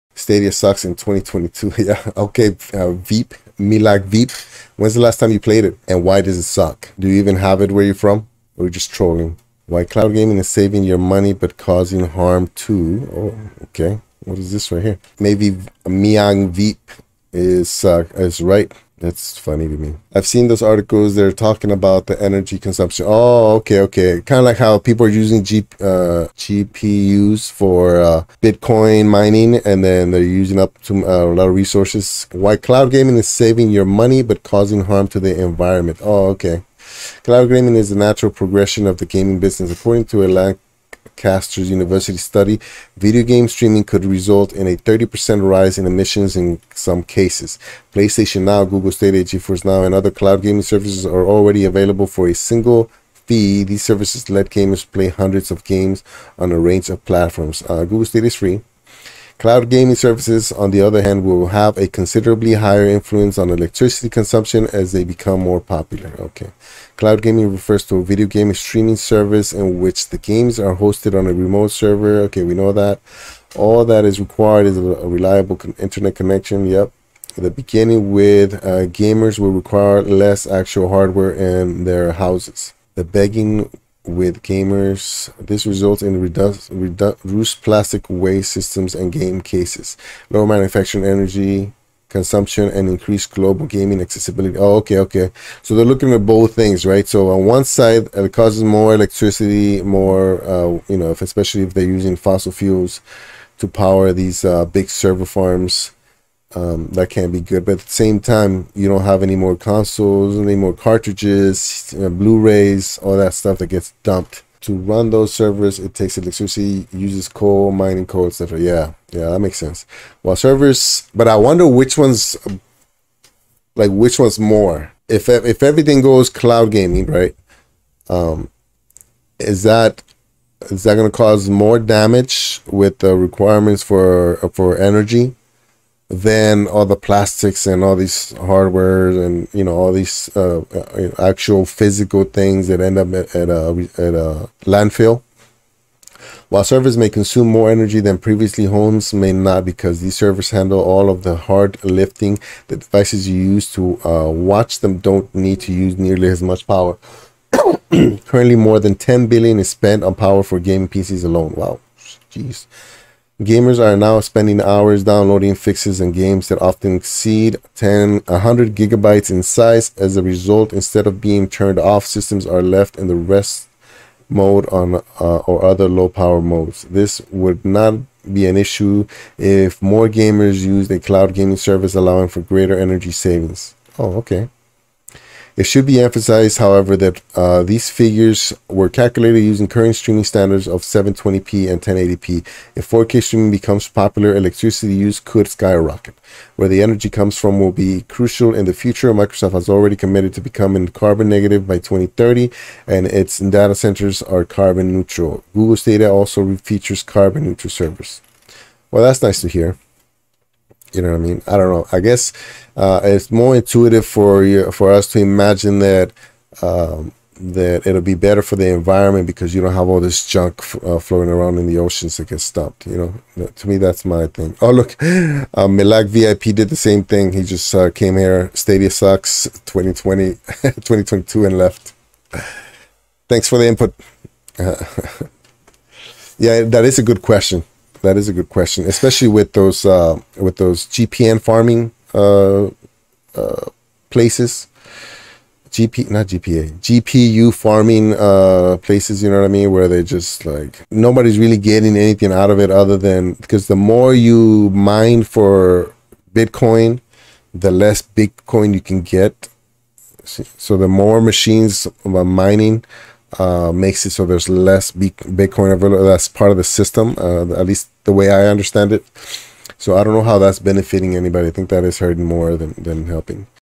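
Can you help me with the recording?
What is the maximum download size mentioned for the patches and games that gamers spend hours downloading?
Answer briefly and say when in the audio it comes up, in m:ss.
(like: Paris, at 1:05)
100 gigabytes, at 2:48.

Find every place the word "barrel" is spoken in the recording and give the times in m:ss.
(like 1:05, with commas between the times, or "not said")
not said.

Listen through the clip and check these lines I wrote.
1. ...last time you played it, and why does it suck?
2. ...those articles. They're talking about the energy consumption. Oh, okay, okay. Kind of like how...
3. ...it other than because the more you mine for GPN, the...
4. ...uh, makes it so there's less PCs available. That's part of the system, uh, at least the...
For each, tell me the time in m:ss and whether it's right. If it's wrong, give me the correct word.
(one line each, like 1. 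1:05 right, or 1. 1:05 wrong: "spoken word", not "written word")
1. 0:05 right
2. 0:20 right
3. 4:12 wrong: "Bitcoin", not "GPN"
4. 4:23 wrong: "Bitcoin", not "PCs".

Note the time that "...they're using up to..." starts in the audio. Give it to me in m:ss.
0:30.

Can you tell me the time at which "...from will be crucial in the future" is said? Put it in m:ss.
3:17.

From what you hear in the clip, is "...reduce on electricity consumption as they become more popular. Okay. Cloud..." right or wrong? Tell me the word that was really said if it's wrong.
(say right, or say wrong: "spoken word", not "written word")
wrong: "influence", not "reduce".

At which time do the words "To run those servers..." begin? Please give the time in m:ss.
1:54.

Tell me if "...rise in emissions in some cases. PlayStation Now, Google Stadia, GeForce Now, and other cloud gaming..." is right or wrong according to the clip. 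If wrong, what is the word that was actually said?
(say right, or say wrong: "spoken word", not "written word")
right.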